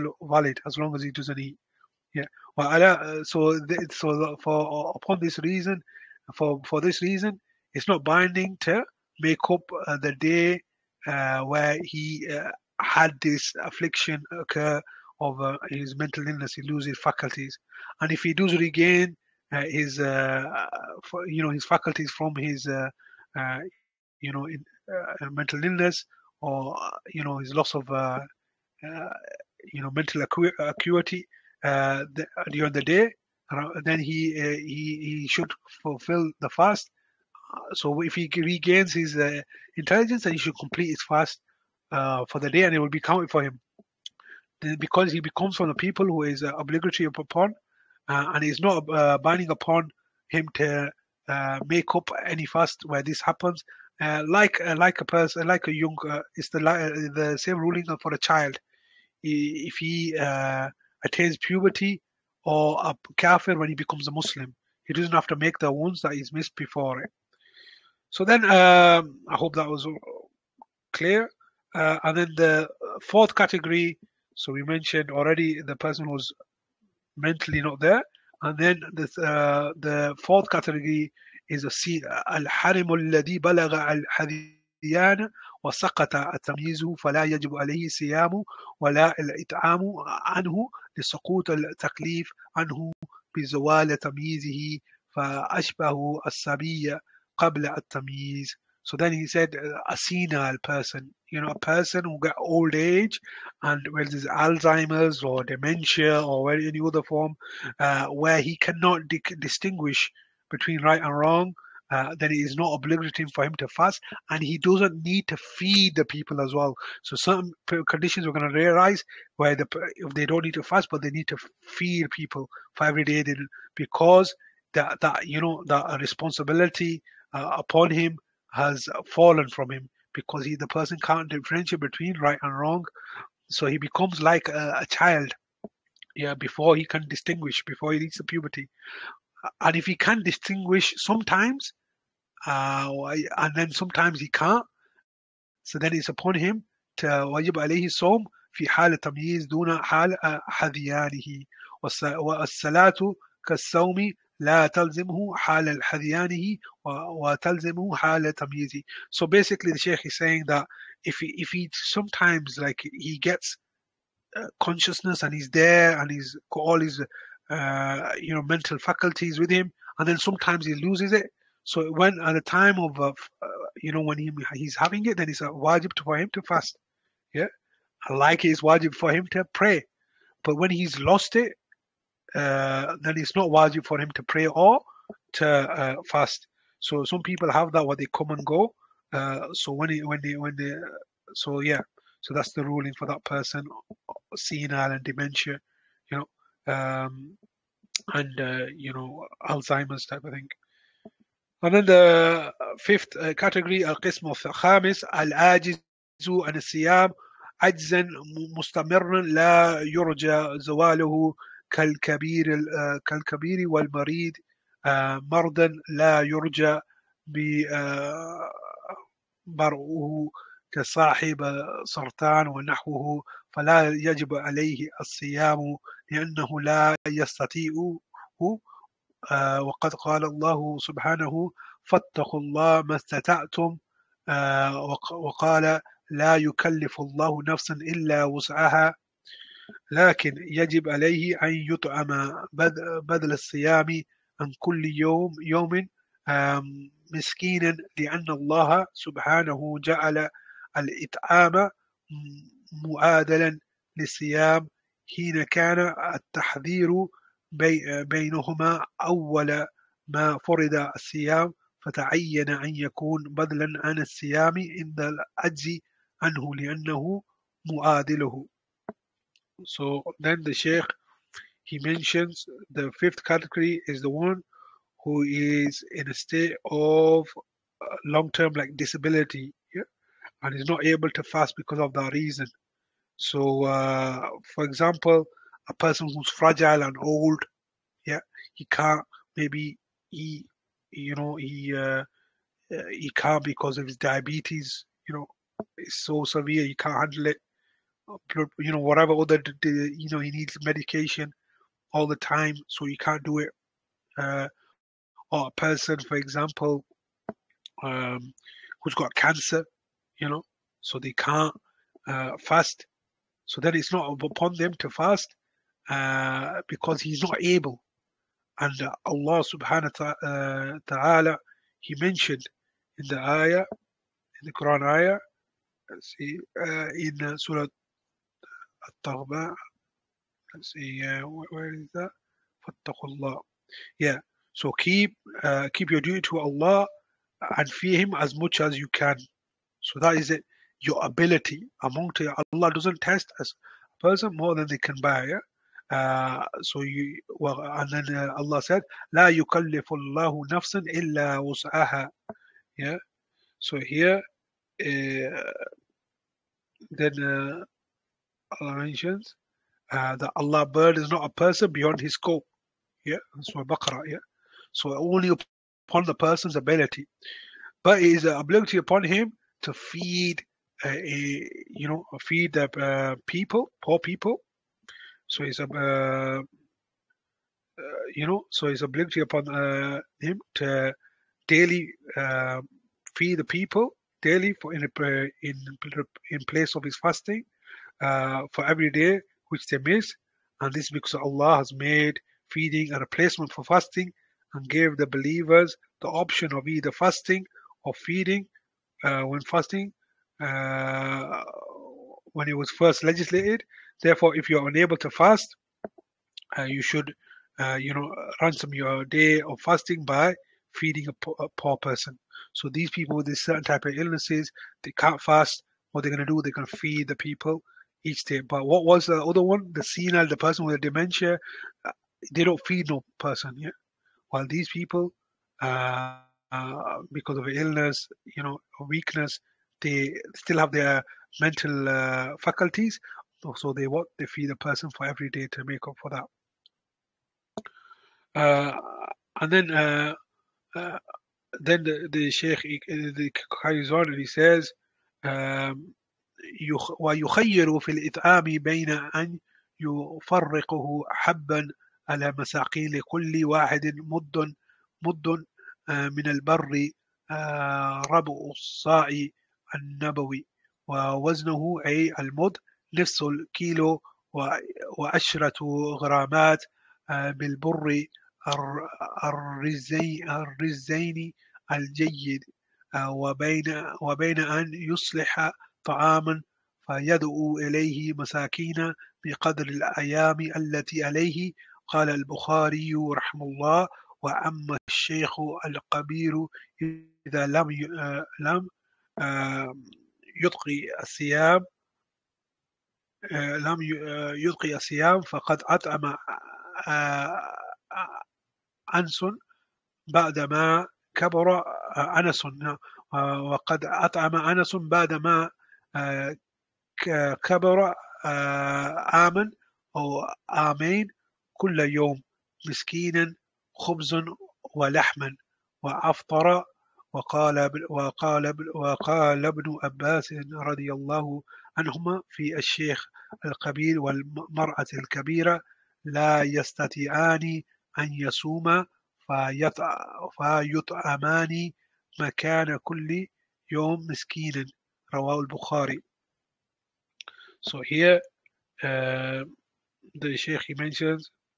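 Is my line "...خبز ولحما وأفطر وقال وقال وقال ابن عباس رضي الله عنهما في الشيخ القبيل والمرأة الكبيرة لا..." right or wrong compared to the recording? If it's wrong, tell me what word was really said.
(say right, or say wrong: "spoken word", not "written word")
right.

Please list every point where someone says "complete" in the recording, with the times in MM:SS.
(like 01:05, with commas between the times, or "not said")
00:40.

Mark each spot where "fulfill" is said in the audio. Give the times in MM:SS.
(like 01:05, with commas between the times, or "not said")
00:35.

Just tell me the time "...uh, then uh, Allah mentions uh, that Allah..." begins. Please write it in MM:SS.
05:54.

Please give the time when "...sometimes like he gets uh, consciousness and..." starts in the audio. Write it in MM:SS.
02:41.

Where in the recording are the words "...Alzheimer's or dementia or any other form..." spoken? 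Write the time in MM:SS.
01:44.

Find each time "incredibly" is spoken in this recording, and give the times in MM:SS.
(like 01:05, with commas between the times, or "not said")
not said.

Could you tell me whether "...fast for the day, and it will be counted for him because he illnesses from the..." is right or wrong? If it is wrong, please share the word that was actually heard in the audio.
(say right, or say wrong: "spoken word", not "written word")
wrong: "becomes", not "illnesses".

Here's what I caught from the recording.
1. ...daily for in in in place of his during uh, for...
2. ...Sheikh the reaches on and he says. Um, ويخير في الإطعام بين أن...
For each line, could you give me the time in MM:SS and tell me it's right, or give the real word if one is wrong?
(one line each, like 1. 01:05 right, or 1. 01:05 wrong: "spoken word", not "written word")
1. 06:24 wrong: "fasting", not "during"
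2. 07:22 wrong: "carries", not "reaches".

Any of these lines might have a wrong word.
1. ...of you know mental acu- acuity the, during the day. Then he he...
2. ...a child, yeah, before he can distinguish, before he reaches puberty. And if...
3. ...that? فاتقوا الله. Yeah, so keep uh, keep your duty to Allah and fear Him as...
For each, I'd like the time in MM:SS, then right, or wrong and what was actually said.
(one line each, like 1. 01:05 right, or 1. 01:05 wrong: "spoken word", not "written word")
1. 00:27 right
2. 02:14 right
3. 05:31 right.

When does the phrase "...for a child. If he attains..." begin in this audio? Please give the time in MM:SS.
00:58.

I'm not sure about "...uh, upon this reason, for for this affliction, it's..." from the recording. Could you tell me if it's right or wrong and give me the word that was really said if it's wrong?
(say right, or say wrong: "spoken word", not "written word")
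wrong: "reason", not "affliction".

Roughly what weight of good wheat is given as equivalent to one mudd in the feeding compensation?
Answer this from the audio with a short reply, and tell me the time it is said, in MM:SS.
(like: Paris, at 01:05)
half a kilo and 10 grams, at 07:42.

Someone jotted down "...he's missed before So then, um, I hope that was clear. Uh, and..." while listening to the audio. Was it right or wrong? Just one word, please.
right.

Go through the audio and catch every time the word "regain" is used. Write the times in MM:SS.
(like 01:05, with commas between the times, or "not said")
00:18, 00:38.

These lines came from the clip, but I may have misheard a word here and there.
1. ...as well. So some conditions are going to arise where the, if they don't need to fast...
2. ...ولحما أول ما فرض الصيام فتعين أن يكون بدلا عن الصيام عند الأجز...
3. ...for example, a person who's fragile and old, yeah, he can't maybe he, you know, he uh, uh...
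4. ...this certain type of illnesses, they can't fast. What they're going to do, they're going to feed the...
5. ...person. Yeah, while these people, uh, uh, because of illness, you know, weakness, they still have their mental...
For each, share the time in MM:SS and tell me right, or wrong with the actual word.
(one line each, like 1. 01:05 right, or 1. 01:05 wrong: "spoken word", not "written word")
1. 01:56 right
2. 04:18 wrong: "بينهما", not "ولحما"
3. 04:44 right
4. 06:53 right
5. 07:03 right.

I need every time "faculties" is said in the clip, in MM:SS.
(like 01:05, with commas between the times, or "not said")
00:17, 00:21, 02:48, 07:12.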